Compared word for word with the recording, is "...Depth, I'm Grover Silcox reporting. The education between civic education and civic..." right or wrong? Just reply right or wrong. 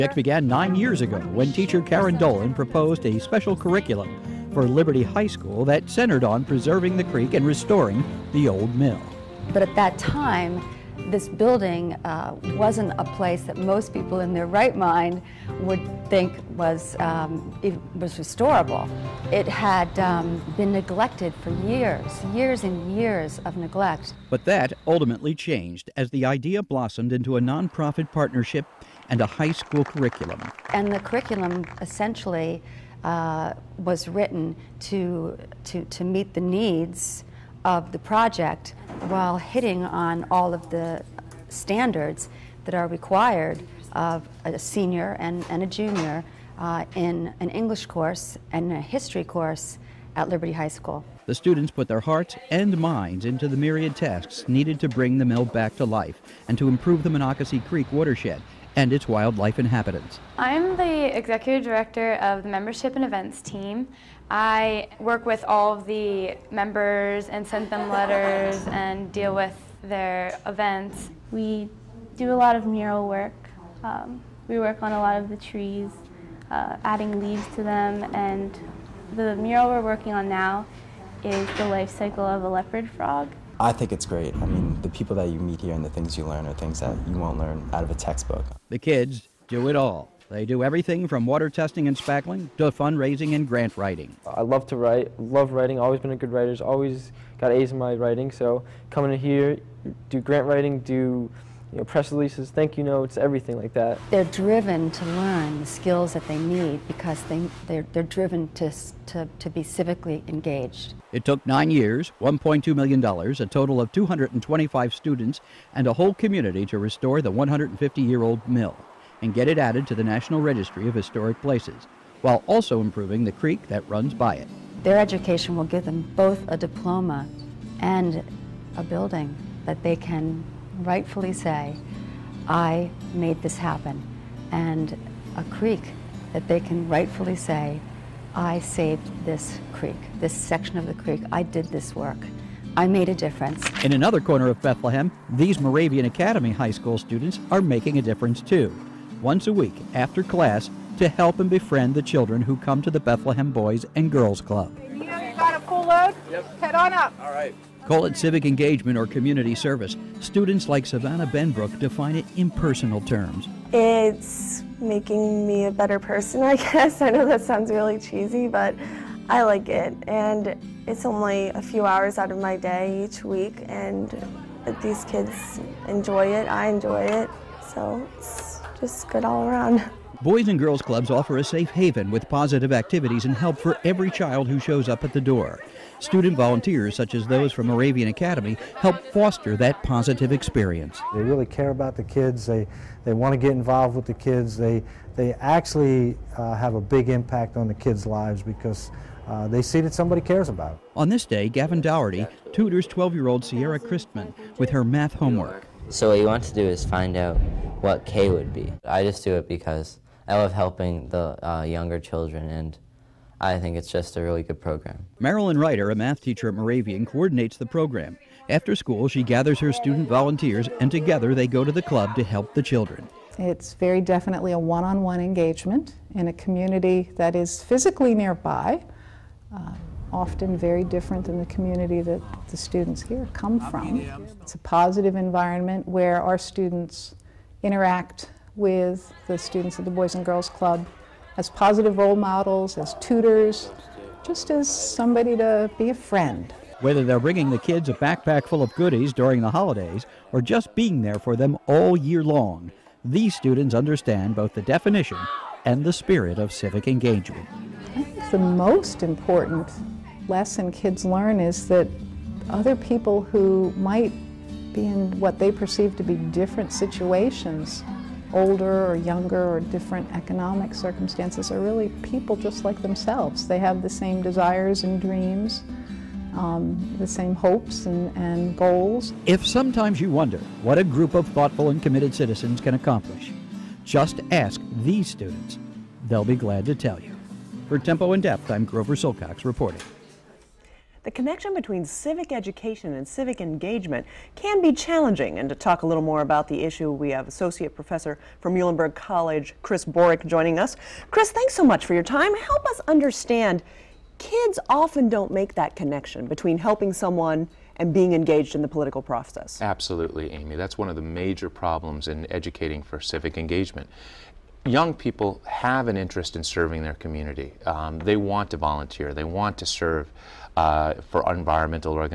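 wrong.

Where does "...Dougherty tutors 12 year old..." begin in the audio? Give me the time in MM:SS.
03:21.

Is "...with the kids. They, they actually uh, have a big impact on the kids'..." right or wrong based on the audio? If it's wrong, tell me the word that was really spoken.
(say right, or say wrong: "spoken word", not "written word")
right.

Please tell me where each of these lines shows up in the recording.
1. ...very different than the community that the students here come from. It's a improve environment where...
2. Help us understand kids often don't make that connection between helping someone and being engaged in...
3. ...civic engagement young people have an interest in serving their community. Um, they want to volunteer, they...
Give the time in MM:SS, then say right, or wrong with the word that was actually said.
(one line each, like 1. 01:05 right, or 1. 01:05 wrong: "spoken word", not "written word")
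1. 03:50 wrong: "positive", not "improve"
2. 05:02 right
3. 05:13 right.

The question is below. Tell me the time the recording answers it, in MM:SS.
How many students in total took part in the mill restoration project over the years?
01:53.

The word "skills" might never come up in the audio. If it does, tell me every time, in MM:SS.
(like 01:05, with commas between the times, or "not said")
01:45.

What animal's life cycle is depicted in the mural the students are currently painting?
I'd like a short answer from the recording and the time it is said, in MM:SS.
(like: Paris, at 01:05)
leopard frog, at 01:22.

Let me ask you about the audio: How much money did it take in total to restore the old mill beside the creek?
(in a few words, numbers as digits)
$1.2 million.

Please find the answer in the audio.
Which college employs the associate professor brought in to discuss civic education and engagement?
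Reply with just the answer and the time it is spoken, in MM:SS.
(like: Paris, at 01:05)
Muhlenberg College, at 04:58.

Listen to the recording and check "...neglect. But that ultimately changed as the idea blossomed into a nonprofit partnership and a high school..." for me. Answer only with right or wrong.
right.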